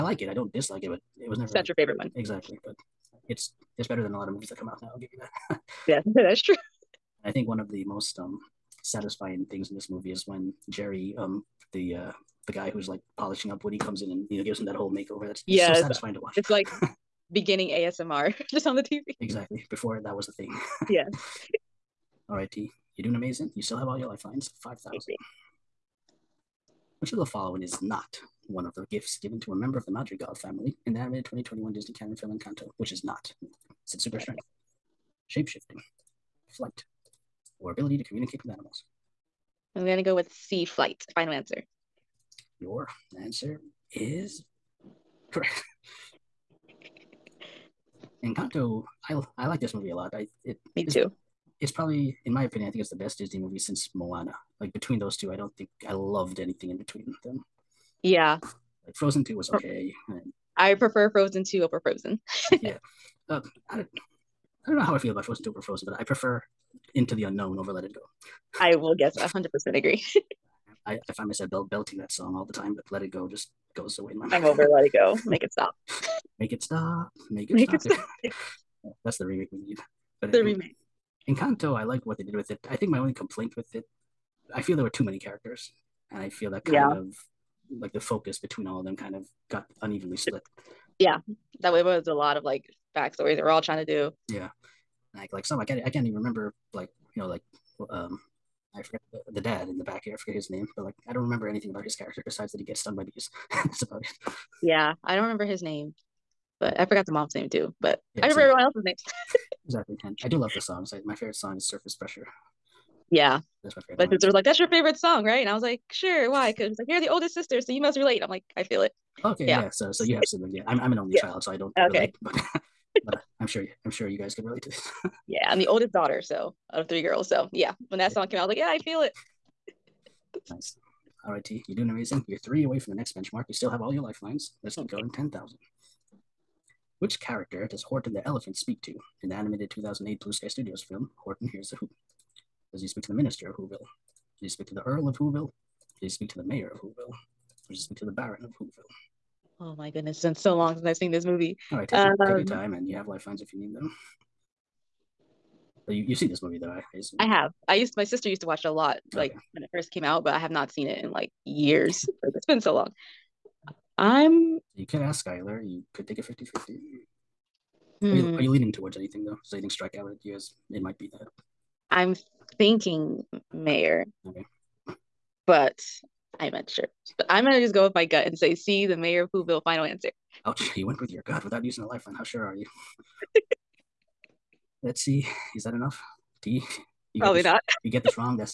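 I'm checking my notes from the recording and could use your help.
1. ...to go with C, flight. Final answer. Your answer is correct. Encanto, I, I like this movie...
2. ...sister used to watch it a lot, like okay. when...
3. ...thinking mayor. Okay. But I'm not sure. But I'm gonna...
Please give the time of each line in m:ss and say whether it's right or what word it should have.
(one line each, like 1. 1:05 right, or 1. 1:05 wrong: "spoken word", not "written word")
1. 0:39 right
2. 2:38 right
3. 2:52 right.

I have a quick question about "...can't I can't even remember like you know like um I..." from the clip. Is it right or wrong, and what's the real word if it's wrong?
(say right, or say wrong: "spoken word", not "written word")
right.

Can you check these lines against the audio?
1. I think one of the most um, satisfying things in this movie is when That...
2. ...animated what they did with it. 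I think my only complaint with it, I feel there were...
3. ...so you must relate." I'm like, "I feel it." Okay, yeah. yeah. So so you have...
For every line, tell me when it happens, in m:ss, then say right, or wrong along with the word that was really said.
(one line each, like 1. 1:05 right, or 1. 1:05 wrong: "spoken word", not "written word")
1. 0:07 wrong: "Jerry", not "That"
2. 1:21 wrong: "liked", not "animated"
3. 1:57 right.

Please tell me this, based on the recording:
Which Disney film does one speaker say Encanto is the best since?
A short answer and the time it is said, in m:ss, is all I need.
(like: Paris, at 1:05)
Moana, at 0:53.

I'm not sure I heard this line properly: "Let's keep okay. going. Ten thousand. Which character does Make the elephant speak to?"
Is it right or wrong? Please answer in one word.
wrong.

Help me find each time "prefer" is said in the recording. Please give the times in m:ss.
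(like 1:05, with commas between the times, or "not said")
1:00, 1:06.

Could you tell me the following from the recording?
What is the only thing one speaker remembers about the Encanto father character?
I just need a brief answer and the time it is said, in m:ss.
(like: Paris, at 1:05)
He gets stung by bees, at 1:42.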